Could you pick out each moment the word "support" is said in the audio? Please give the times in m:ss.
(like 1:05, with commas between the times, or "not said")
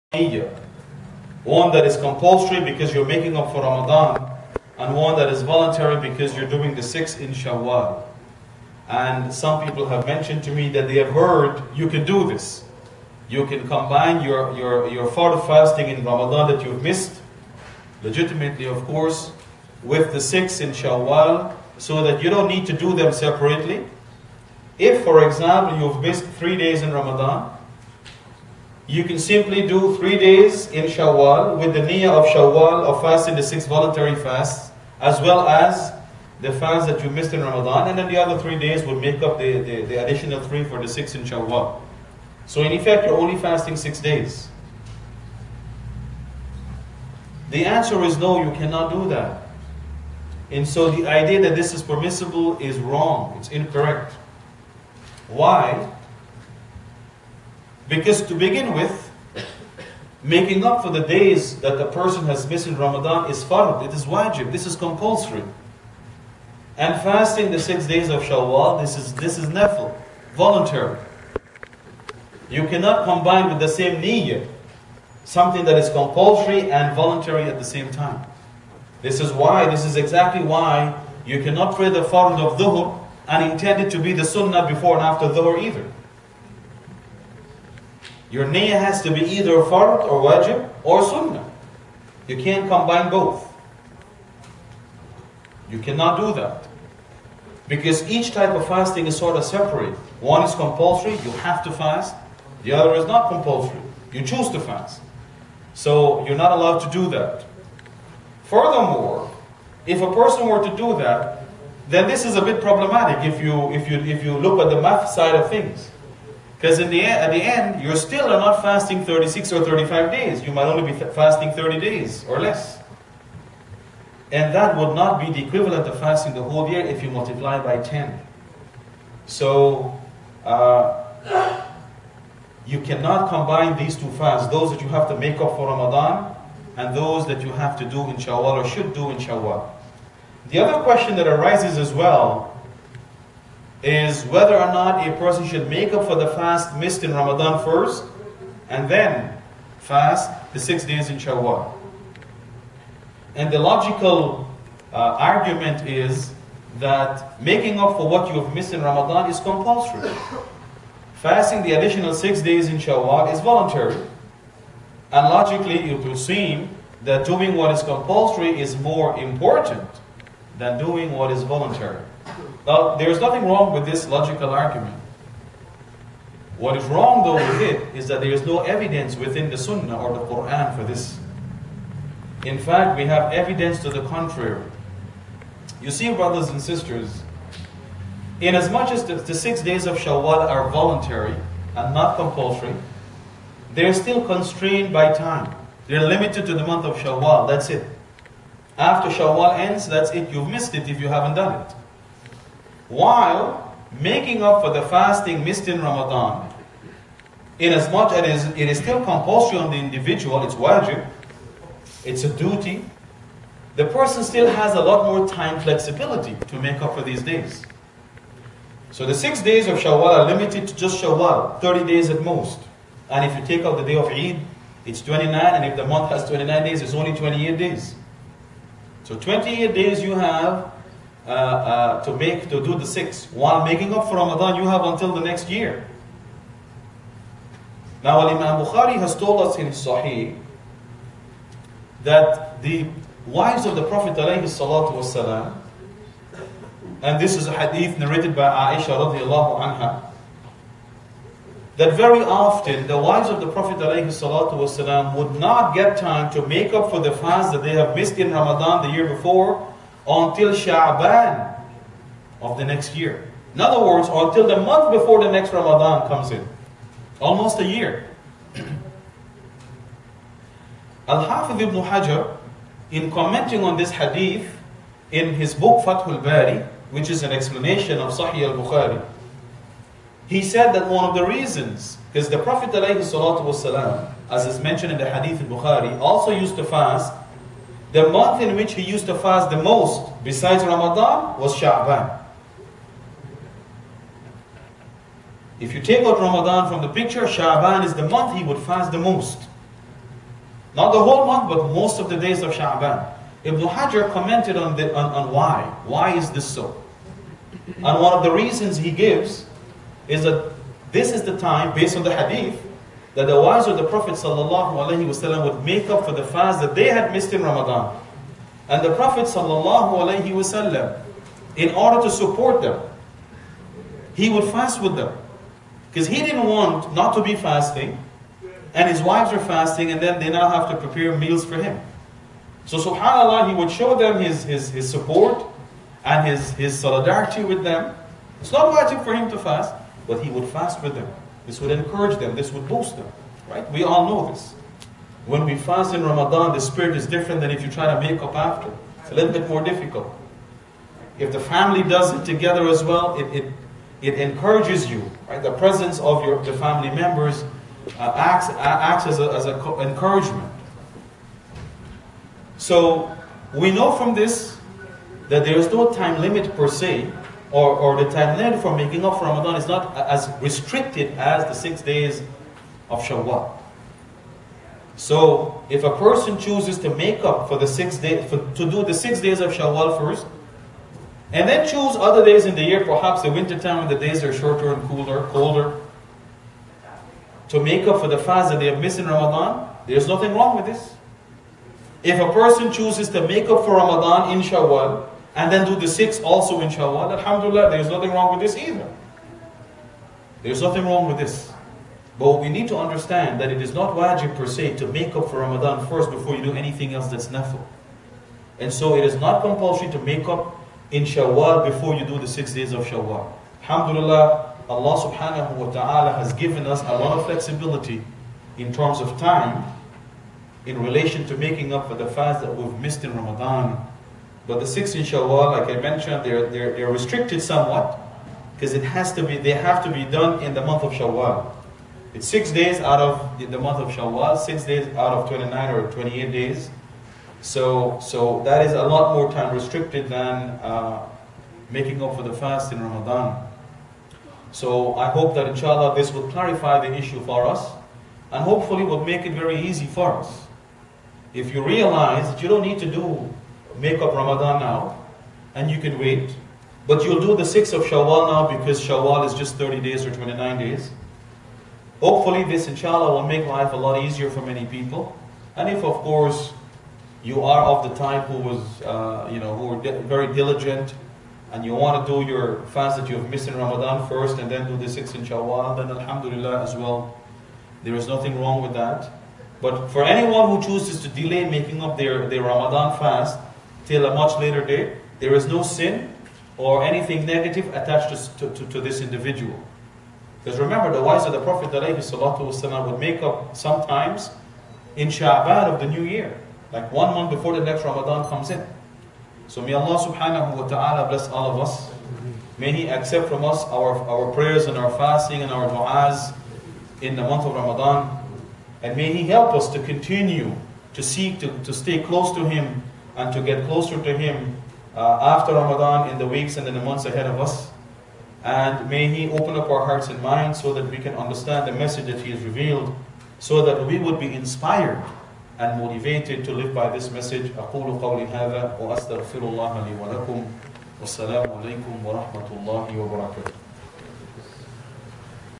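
5:22, 5:34.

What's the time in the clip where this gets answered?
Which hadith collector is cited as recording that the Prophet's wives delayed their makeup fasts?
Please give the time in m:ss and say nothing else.
3:58.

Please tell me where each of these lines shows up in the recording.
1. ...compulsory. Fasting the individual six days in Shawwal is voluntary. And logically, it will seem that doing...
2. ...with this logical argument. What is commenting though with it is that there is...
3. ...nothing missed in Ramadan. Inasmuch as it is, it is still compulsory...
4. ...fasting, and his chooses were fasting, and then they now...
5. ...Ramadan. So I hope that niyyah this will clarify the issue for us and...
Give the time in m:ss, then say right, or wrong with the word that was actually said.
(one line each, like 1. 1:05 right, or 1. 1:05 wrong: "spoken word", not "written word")
1. 2:39 wrong: "additional", not "individual"
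2. 2:53 wrong: "wrong", not "commenting"
3. 3:24 wrong: "fasting", not "nothing"
4. 5:27 wrong: "wives", not "chooses"
5. 7:22 wrong: "inshallah", not "niyyah".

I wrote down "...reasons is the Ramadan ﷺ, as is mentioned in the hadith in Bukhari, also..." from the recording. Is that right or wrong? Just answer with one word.
wrong.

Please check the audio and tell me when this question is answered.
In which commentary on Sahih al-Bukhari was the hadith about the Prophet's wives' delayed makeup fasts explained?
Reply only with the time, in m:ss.
4:35.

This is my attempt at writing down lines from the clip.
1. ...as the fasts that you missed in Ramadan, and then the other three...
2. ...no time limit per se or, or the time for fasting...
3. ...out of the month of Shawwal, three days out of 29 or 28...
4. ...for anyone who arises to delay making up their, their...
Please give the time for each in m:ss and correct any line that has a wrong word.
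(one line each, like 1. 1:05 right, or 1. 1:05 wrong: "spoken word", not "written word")
1. 0:35 right
2. 6:05 wrong: "making", not "fasting"
3. 7:12 wrong: "six", not "three"
4. 7:59 wrong: "chooses", not "arises".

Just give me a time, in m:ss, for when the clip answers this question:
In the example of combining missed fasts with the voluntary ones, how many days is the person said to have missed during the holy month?
0:26.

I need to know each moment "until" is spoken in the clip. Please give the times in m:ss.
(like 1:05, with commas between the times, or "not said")
3:54, 4:20, 4:24.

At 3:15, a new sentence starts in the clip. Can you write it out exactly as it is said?
They're limited to the month of Shawwal, that's it.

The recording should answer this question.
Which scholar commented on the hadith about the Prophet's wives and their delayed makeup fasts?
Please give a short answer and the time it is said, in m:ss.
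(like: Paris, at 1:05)
Al-Hafiz ibn Hajar, at 4:31.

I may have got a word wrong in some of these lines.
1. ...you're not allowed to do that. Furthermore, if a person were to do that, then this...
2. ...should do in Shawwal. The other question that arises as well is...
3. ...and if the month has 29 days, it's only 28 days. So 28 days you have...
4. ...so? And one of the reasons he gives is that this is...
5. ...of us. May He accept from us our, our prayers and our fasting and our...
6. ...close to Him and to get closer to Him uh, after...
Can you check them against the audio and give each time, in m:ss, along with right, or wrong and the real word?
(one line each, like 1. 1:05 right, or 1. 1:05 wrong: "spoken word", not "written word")
1. 1:46 right
2. 2:18 right
3. 3:45 right
4. 5:06 right
5. 8:21 right
6. 8:32 right.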